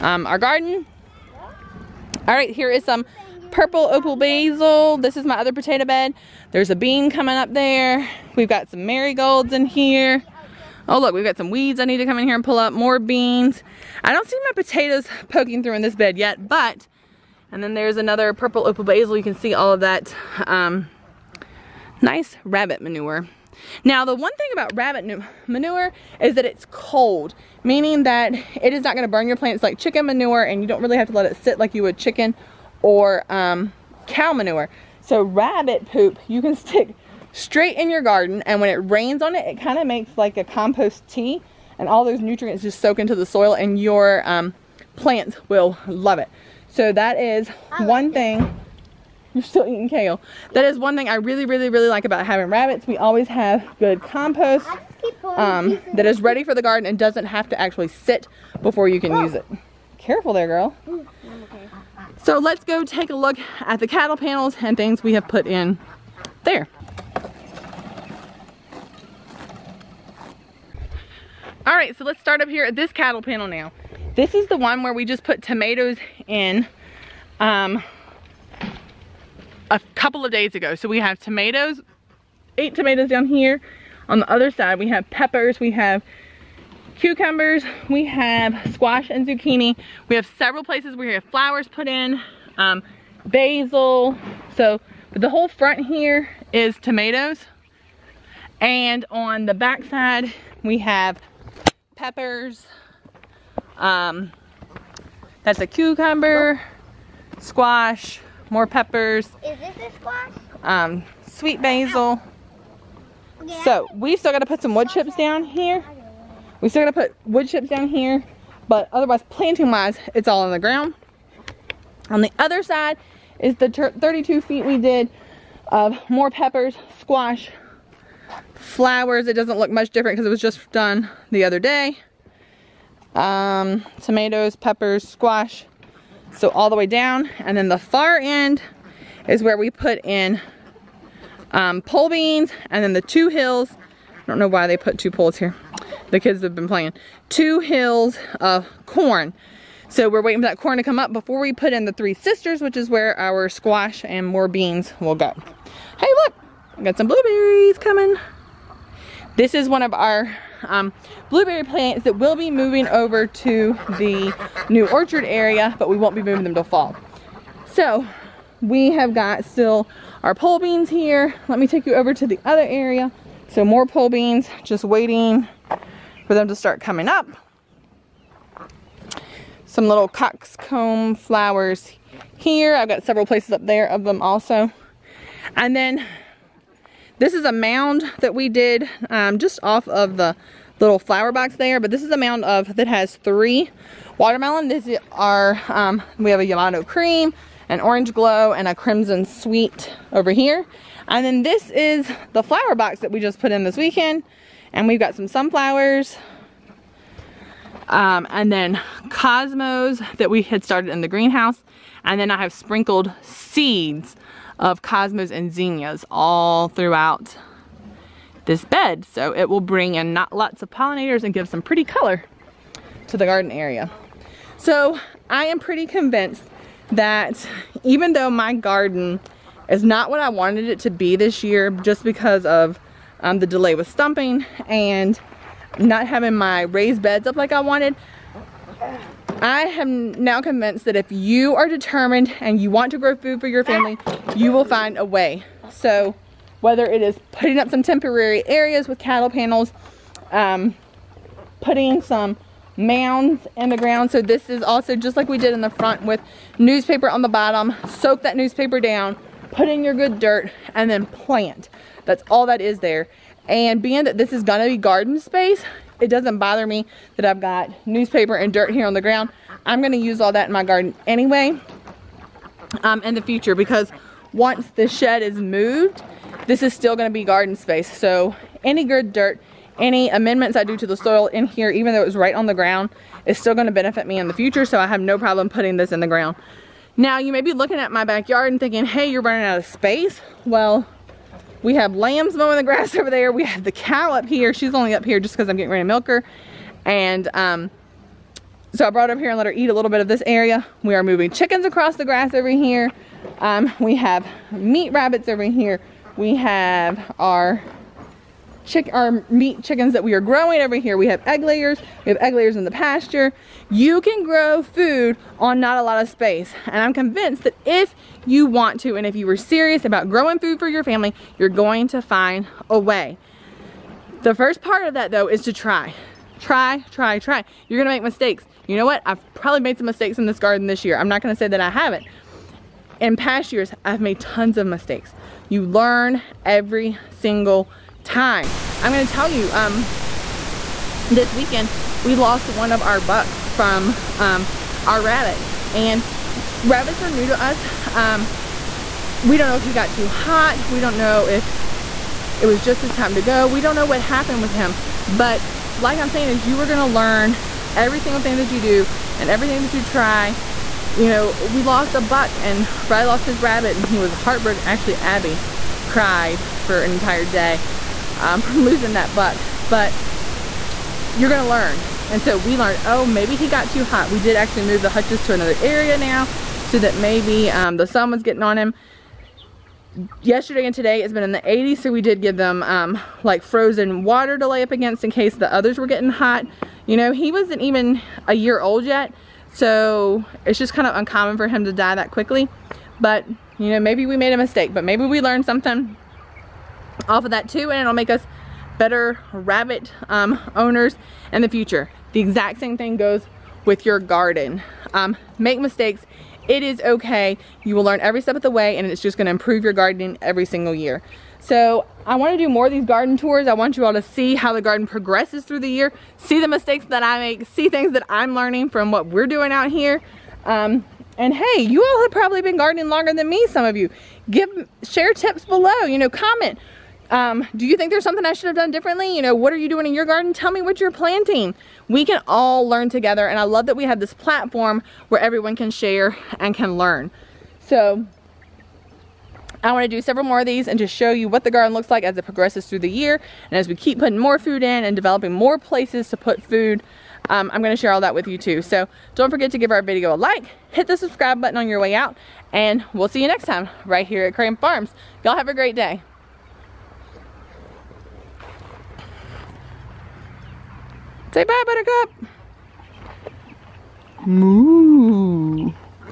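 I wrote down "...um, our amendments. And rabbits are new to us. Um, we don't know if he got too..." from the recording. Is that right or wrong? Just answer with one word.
wrong.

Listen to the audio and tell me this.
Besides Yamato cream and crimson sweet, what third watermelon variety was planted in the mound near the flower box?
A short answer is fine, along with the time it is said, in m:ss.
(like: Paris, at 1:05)
Orange glow, at 3:17.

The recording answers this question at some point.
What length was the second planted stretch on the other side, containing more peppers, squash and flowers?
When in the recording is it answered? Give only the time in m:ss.
2:03.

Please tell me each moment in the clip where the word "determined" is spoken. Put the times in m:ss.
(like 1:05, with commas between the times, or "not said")
4:01.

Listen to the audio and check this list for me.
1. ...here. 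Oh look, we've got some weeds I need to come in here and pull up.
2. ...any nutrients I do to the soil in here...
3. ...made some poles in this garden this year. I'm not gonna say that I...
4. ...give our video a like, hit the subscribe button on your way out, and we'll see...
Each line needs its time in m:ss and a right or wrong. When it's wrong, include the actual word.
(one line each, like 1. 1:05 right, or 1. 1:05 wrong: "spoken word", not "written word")
1. 0:09 right
2. 4:39 wrong: "amendments", not "nutrients"
3. 5:29 wrong: "mistakes", not "poles"
4. 7:29 right.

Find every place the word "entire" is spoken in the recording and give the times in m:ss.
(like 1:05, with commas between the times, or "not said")
6:06.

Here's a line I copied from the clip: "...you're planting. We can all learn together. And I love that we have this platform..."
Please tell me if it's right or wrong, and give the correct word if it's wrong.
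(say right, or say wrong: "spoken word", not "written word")
right.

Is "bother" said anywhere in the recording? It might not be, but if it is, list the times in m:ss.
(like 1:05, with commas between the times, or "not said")
4:26.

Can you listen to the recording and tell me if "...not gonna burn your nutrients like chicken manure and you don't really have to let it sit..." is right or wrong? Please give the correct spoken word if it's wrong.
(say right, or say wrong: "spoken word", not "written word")
wrong: "plants", not "nutrients".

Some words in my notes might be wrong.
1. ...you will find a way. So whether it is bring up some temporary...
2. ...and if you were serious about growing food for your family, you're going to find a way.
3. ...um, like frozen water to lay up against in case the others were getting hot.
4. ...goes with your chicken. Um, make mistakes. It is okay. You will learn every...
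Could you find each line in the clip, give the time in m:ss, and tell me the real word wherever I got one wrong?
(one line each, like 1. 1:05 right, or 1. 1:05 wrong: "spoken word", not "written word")
1. 4:04 wrong: "putting", not "bring"
2. 5:18 right
3. 6:22 right
4. 6:42 wrong: "garden", not "chicken".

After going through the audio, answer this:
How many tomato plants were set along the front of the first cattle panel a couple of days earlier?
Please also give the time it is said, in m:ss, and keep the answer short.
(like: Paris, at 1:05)
8, at 1:22.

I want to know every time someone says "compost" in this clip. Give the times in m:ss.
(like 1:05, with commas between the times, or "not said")
0:40, 0:54.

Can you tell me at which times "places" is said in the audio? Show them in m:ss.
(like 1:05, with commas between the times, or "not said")
1:30, 3:03, 7:25.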